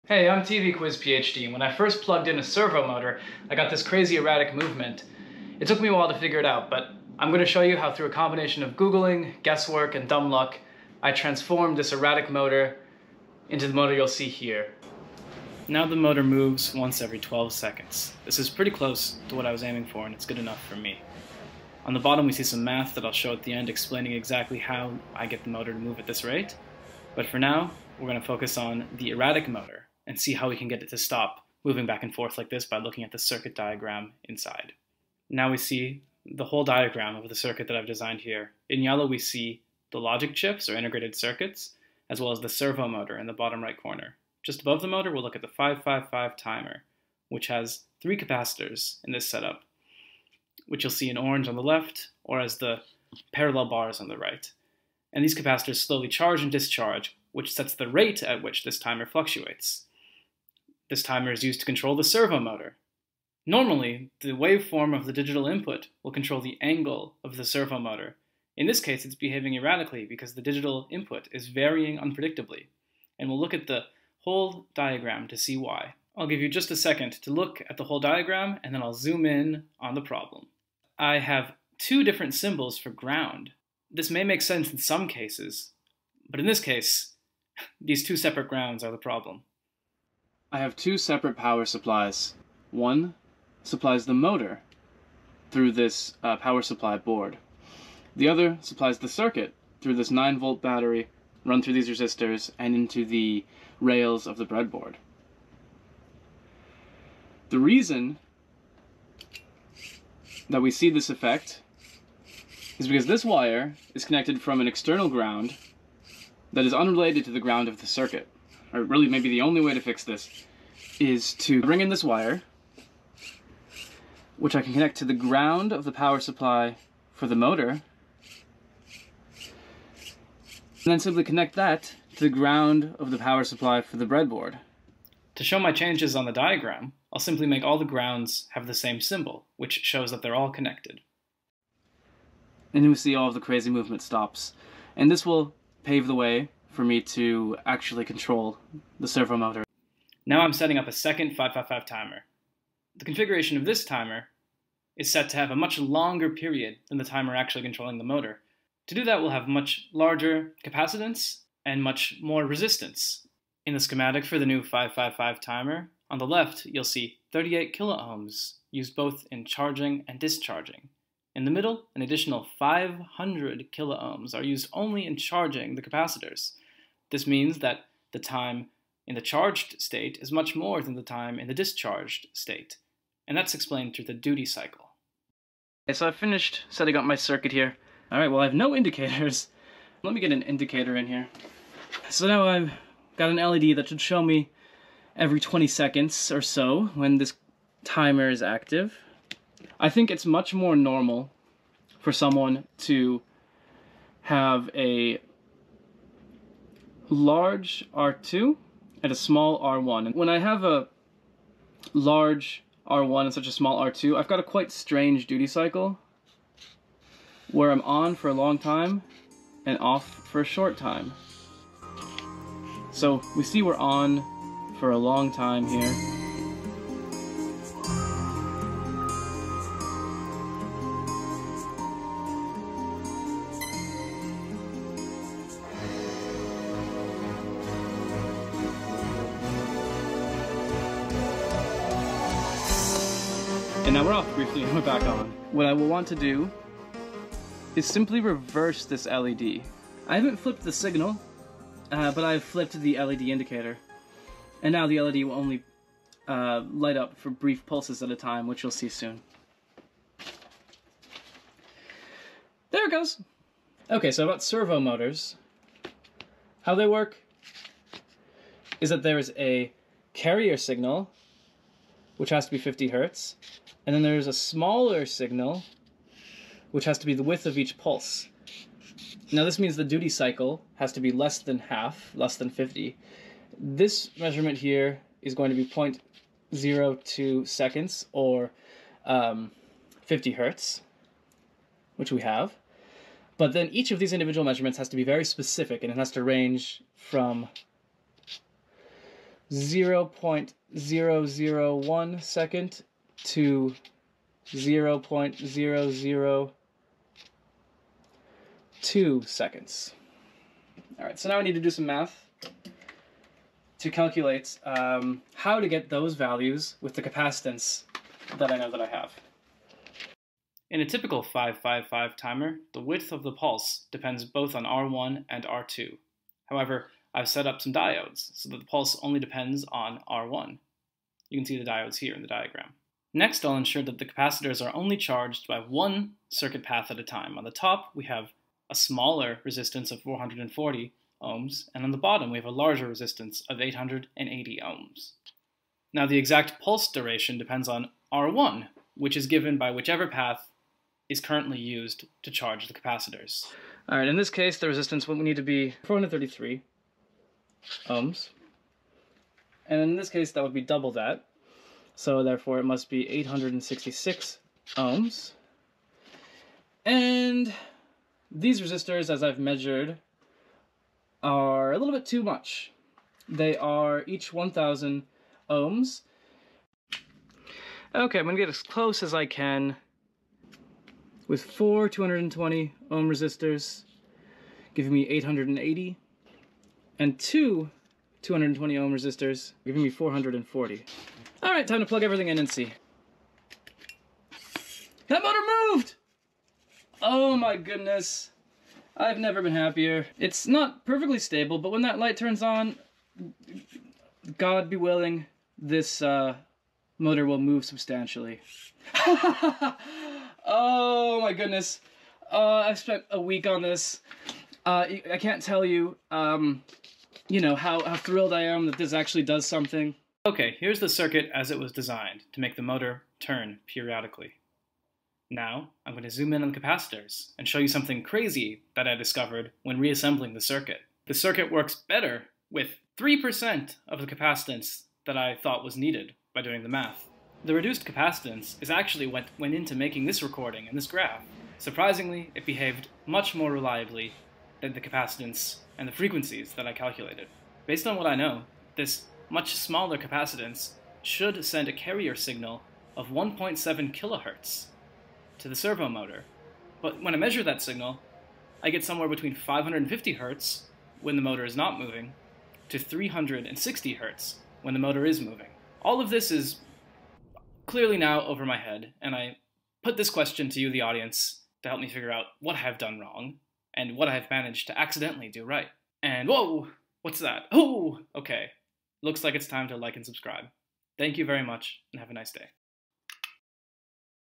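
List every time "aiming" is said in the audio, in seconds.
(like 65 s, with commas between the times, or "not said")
19 s.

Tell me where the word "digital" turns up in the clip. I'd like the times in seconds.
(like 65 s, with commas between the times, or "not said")
65 s, 70 s.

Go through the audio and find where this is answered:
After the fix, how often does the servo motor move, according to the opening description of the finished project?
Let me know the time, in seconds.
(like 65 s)
16 s.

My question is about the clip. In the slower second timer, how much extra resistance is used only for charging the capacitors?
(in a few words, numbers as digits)
500 kiloohms.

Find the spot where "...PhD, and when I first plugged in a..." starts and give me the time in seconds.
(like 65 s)
0 s.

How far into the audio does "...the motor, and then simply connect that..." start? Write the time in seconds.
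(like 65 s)
127 s.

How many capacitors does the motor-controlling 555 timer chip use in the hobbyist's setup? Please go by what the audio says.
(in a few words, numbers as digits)
3.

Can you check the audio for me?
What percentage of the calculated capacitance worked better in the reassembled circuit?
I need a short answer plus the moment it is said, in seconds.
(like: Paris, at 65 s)
3%, at 432 s.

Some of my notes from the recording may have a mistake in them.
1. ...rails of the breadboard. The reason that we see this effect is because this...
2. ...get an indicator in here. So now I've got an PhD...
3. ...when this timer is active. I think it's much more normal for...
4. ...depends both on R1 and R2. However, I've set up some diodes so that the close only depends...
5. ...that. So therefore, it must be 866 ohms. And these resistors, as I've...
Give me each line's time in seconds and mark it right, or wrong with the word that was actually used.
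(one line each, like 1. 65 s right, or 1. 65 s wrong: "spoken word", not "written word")
1. 103 s right
2. 190 s wrong: "LED", not "PhD"
3. 196 s right
4. 323 s wrong: "pulse", not "close"
5. 360 s right.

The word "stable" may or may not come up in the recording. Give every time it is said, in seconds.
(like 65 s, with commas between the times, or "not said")
401 s.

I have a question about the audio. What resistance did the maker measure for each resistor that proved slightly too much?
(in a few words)
1,000 ohms.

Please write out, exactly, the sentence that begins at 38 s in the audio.
In yellow we see the logic chips or integrated circuits, as well as the servo motor in the bottom right corner.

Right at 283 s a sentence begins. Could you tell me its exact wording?
This measurement here is going to be 0.02 seconds or um, 50 hertz, which we have.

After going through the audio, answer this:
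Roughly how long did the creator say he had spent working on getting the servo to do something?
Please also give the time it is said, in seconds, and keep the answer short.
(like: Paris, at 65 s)
A week, at 413 s.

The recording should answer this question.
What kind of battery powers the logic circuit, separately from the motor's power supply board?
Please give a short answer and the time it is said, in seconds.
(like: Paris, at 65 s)
9 volt battery, at 100 s.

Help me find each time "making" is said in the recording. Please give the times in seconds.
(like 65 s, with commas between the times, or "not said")
439 s.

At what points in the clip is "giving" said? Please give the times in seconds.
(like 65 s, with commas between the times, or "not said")
384 s, 389 s.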